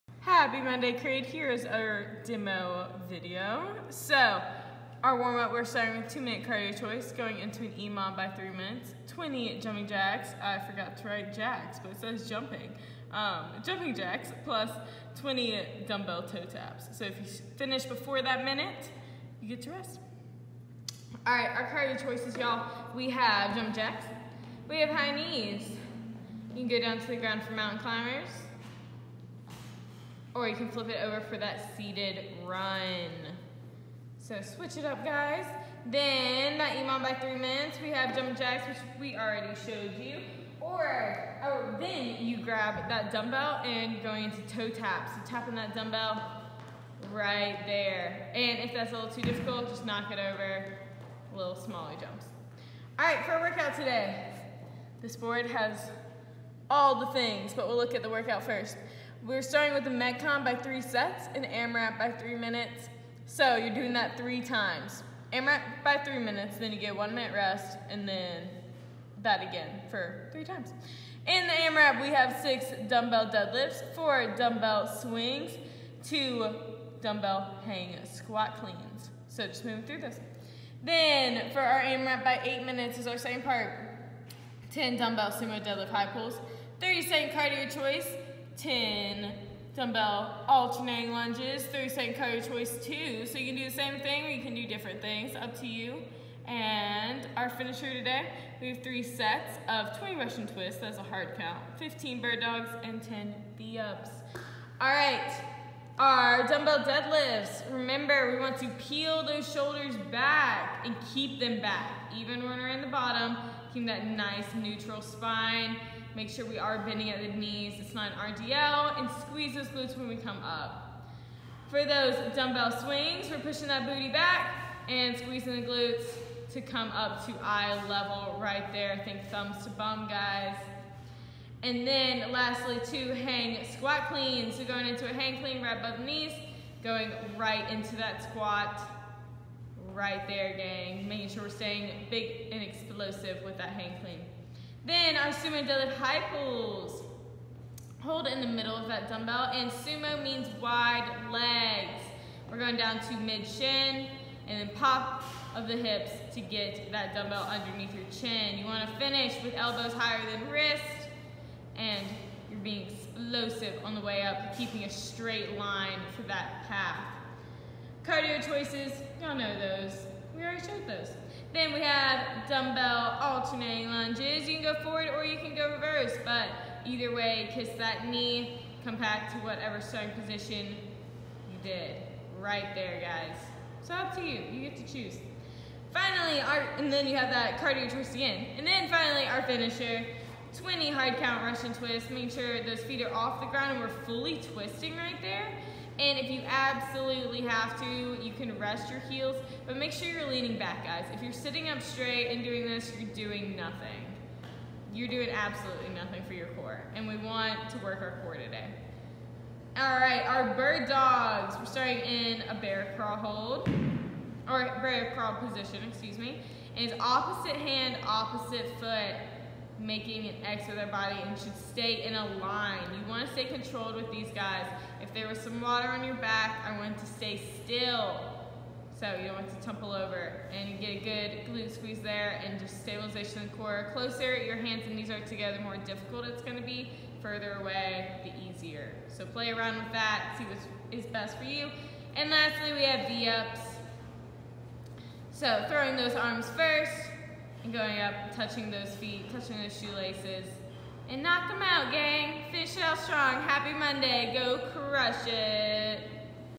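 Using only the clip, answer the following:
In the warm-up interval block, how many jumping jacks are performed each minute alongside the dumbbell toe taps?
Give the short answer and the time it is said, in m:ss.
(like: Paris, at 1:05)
20, at 0:09.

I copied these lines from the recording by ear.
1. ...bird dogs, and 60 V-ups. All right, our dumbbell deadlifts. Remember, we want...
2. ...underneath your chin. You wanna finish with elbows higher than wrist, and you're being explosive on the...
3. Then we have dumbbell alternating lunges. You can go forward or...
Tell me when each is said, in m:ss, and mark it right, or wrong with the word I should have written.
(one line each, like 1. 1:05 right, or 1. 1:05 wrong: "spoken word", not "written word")
1. 1:42 wrong: "10", not "60"
2. 2:37 right
3. 2:51 right.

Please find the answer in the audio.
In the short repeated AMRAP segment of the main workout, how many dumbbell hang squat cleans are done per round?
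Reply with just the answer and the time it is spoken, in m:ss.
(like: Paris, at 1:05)
2, at 1:16.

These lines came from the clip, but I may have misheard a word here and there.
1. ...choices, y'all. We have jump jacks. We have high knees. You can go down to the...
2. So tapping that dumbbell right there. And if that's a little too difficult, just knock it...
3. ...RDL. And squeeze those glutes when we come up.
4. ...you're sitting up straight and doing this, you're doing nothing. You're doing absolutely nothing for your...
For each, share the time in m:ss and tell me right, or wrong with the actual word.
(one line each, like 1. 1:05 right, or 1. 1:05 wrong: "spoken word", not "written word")
1. 0:22 right
2. 0:45 right
3. 1:58 right
4. 3:21 right.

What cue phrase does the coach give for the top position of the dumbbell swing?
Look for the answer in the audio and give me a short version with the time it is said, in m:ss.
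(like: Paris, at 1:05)
thumbs to bum, at 2:09.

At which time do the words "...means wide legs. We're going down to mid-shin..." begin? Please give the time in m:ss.
2:30.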